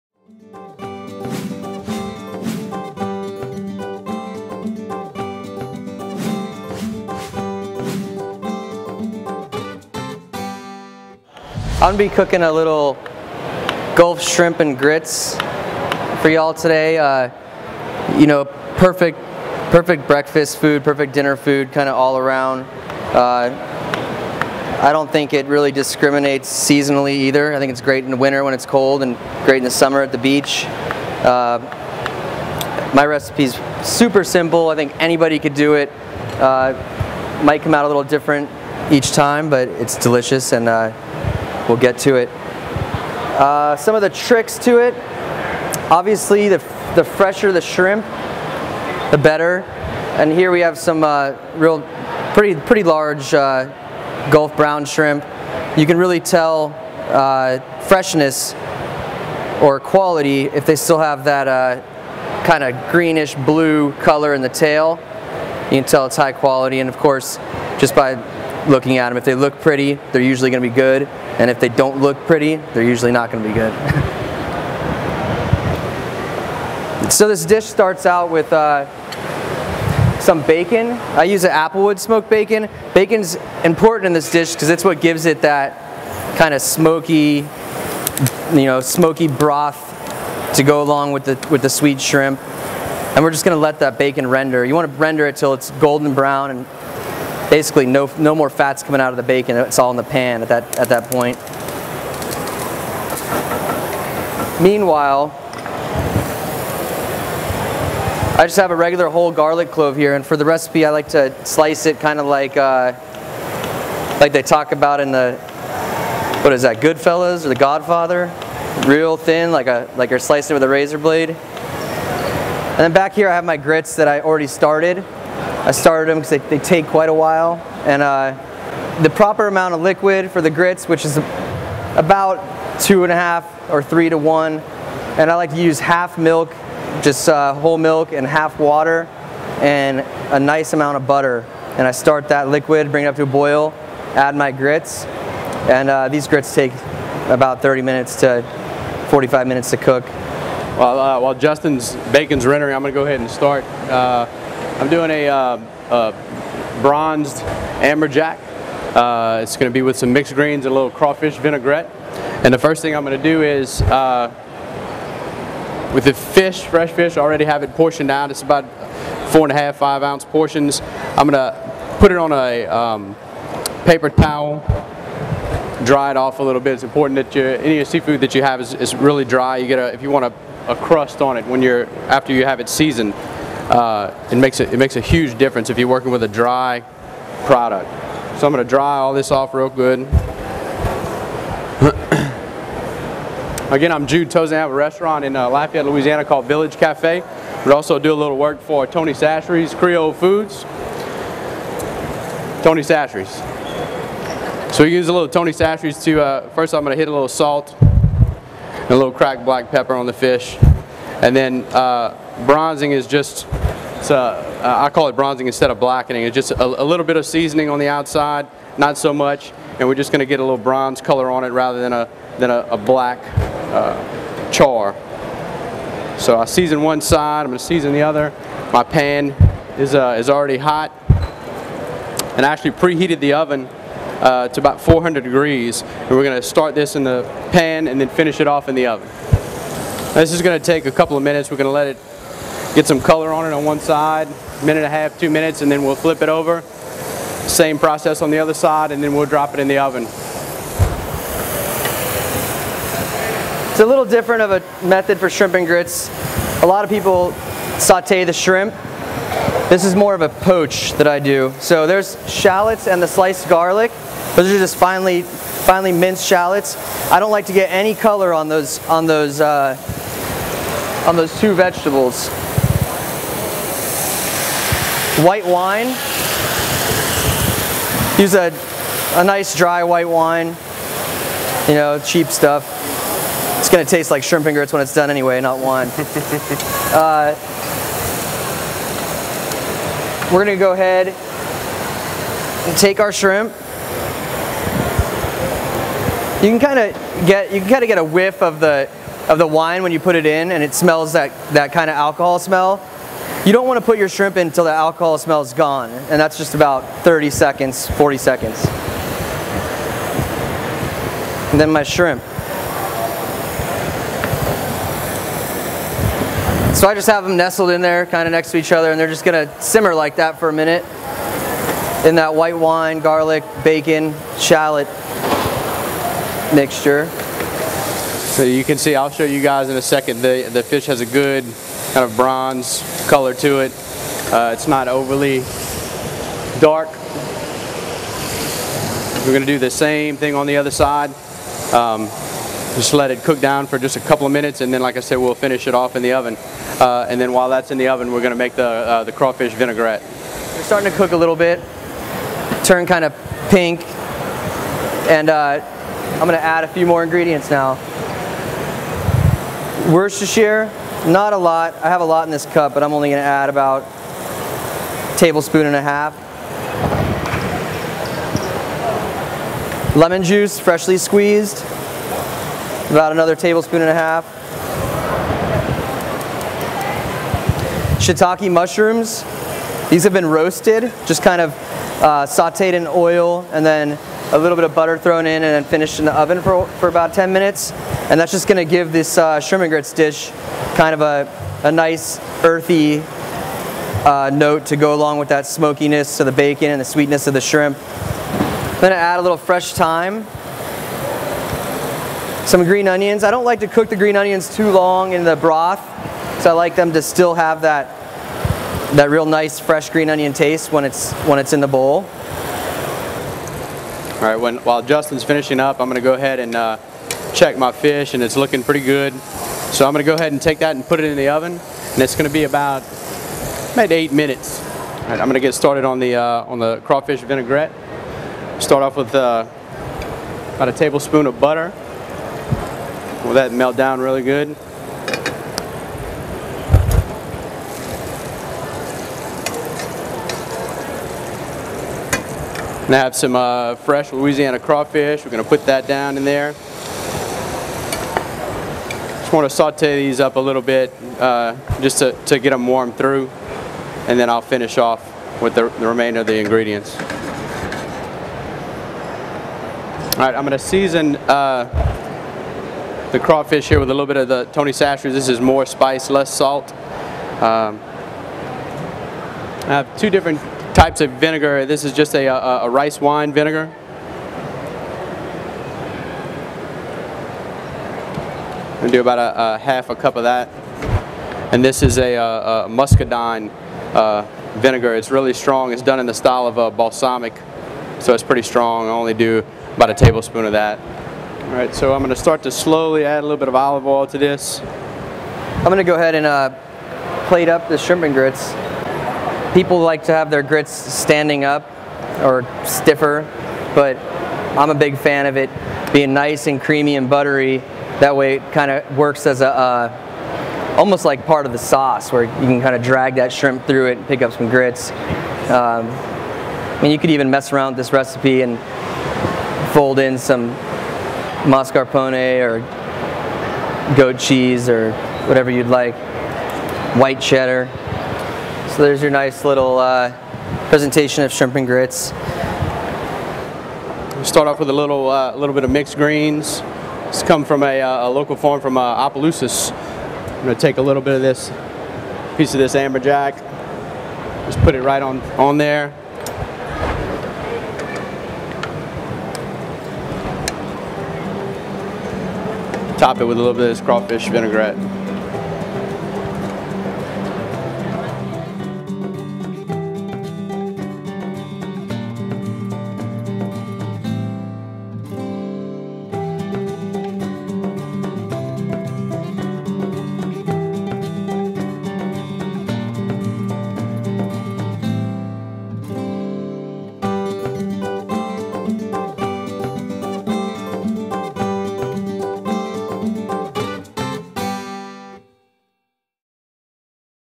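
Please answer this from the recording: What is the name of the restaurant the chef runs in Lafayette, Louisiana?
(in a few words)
Village Cafe.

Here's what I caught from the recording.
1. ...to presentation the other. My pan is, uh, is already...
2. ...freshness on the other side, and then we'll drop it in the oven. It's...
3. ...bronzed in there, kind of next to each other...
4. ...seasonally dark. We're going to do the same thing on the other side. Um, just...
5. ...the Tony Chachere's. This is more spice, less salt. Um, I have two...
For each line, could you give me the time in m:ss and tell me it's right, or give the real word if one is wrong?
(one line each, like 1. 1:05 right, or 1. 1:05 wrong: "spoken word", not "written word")
1. 3:47 wrong: "season", not "presentation"
2. 4:07 wrong: "process", not "freshness"
3. 5:17 wrong: "nestled", not "bronzed"
4. 5:34 wrong: "overly", not "seasonally"
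5. 7:44 right.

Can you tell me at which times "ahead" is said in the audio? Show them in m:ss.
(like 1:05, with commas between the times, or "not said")
2:33, 4:50, 6:56, 7:00, 8:15.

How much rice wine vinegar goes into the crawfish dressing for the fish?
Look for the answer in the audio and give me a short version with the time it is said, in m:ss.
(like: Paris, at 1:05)
half a cup, at 7:59.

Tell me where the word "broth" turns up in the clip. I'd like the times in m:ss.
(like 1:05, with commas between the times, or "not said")
1:29, 6:45.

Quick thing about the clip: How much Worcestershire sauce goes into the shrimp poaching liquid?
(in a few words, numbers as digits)
1.5 tablespoons.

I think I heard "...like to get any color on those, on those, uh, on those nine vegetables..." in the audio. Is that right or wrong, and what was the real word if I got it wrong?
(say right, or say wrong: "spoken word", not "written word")
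wrong: "two", not "nine".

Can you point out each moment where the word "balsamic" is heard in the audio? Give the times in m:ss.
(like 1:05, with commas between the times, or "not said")
8:06.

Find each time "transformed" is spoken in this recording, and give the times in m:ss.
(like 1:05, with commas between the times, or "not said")
not said.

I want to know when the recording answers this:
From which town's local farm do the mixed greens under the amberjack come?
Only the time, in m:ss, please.
8:59.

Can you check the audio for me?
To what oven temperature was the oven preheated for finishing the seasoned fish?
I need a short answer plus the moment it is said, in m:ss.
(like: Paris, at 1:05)
400 degrees, at 3:54.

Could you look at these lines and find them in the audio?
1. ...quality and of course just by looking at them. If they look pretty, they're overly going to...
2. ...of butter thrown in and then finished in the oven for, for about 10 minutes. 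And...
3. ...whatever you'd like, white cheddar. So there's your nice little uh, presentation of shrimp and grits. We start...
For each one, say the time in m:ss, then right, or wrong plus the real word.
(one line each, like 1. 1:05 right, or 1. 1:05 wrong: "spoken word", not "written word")
1. 1:06 wrong: "usually", not "overly"
2. 6:24 right
3. 8:45 right.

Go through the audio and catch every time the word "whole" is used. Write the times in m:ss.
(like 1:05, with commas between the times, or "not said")
1:49, 2:17.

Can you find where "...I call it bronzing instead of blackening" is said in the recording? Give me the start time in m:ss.
3:34.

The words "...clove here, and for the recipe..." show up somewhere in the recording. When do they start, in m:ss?
1:49.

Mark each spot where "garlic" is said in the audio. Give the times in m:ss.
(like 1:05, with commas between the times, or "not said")
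1:49, 4:23, 5:22.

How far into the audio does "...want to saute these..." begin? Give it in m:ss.
7:29.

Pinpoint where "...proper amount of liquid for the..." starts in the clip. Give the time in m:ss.
2:09.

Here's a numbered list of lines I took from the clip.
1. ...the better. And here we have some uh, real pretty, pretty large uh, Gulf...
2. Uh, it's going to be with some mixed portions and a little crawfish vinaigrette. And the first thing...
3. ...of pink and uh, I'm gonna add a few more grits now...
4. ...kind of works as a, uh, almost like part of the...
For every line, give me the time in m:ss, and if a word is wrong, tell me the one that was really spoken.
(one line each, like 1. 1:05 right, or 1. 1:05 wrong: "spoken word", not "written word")
1. 0:49 right
2. 2:38 wrong: "greens", not "portions"
3. 5:53 wrong: "ingredients", not "grits"
4. 8:28 right.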